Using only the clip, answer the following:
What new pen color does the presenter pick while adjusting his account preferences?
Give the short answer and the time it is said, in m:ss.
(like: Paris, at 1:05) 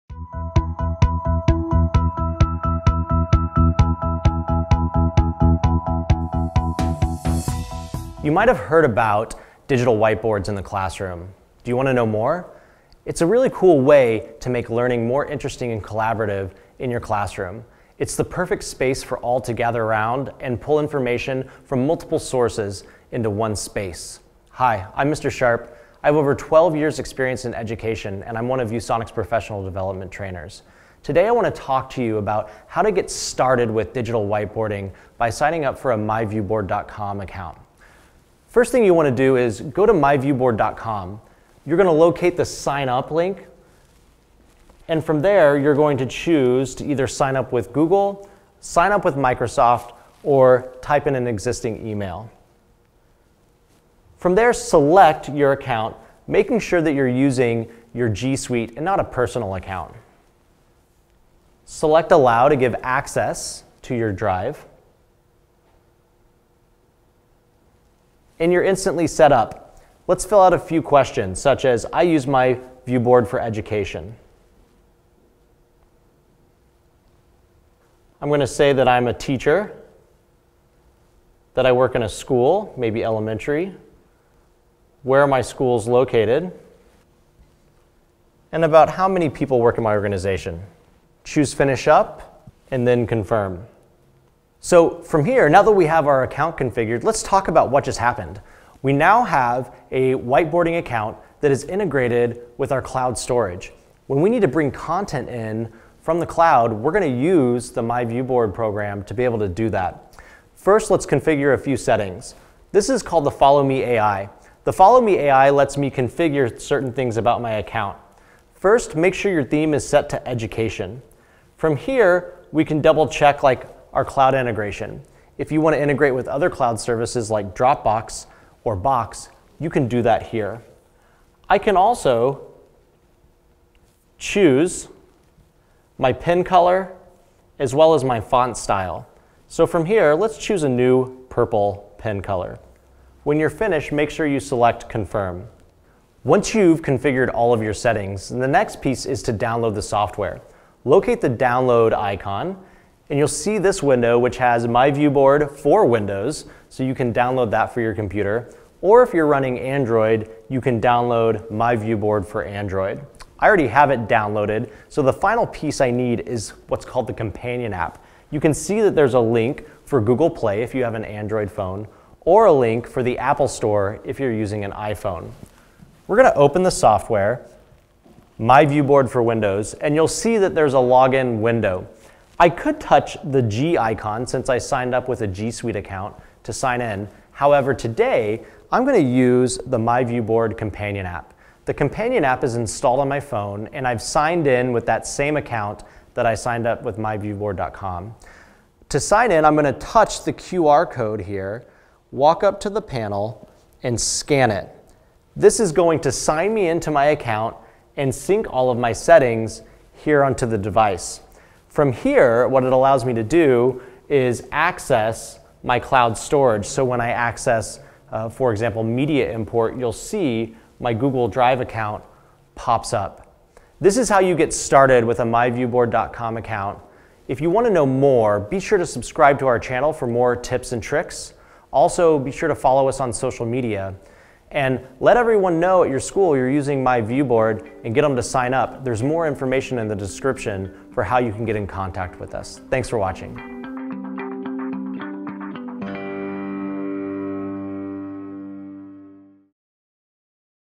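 purple, at 2:21.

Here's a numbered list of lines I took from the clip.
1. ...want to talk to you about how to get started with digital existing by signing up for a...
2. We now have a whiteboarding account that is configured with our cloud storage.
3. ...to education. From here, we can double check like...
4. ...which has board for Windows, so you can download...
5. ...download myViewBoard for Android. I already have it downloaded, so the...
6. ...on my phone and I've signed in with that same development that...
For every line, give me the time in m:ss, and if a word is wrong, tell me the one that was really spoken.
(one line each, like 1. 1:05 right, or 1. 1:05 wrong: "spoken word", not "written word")
1. 0:31 wrong: "whiteboarding", not "existing"
2. 1:38 wrong: "integrated", not "configured"
3. 2:00 right
4. 2:34 wrong: "myViewBoard", not "board"
5. 2:40 right
6. 3:12 wrong: "account", not "development".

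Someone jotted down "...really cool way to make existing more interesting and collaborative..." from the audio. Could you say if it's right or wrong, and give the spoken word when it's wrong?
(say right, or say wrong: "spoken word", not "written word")
wrong: "learning", not "existing".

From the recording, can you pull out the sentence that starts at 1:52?
This is called the Follow Me AI.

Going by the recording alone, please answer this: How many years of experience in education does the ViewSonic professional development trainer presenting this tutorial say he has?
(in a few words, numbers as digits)
12.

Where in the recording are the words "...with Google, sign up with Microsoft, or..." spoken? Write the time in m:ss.
0:47.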